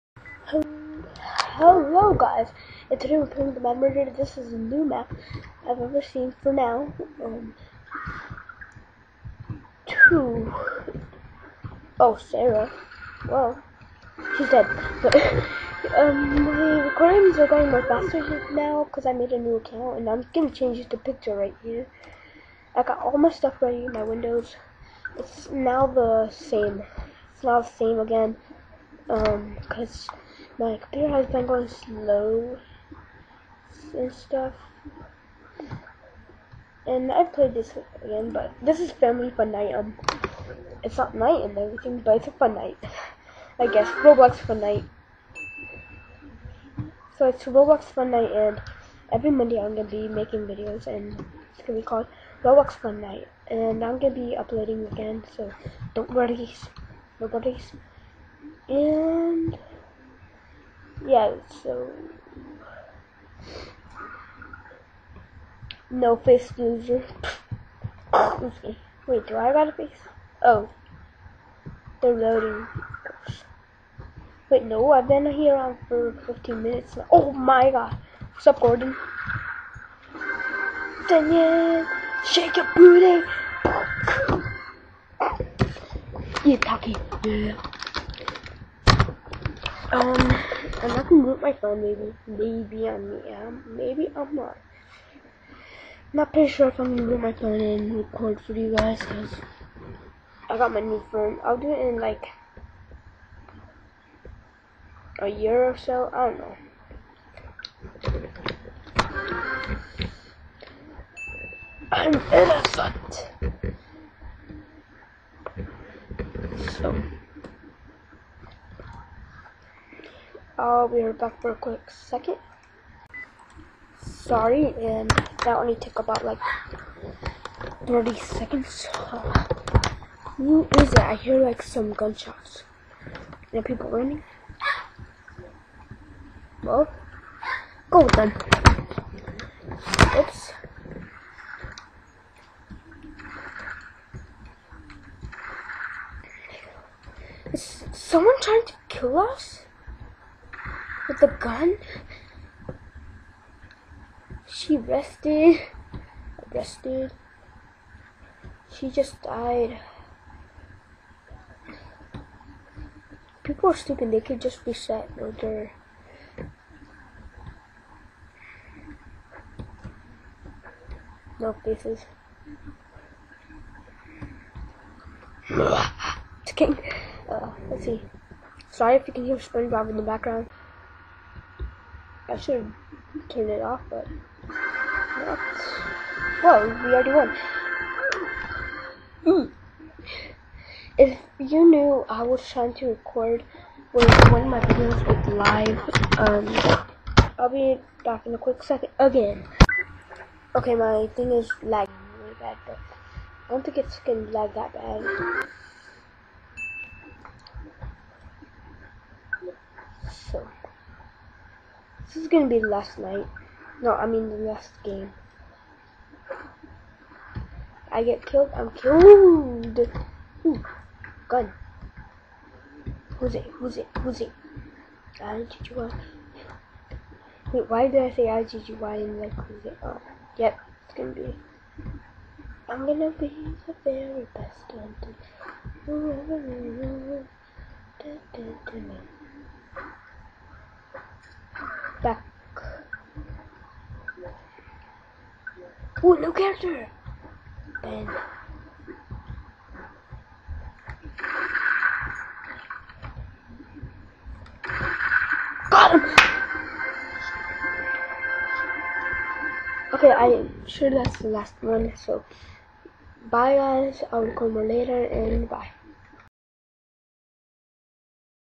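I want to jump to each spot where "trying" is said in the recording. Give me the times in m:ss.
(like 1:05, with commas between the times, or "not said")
2:28, 3:12.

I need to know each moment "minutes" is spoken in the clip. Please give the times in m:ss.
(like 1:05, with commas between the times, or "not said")
1:16.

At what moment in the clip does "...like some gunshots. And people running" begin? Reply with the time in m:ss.
2:11.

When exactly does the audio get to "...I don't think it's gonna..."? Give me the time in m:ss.
3:23.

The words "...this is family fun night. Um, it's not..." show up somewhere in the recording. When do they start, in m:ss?
0:38.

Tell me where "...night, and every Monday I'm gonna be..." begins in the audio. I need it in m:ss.
0:48.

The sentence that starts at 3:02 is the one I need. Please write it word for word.
I should have turned it off, but.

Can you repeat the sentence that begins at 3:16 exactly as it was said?
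Um, I'll be back in a quick second again.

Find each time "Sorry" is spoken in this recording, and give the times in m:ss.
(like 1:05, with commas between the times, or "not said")
2:04, 2:58.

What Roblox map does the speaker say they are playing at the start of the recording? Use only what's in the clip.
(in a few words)
Murder.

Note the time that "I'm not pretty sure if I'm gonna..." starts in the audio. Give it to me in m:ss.
1:34.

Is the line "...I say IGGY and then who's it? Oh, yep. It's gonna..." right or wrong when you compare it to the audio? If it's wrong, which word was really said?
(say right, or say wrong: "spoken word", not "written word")
right.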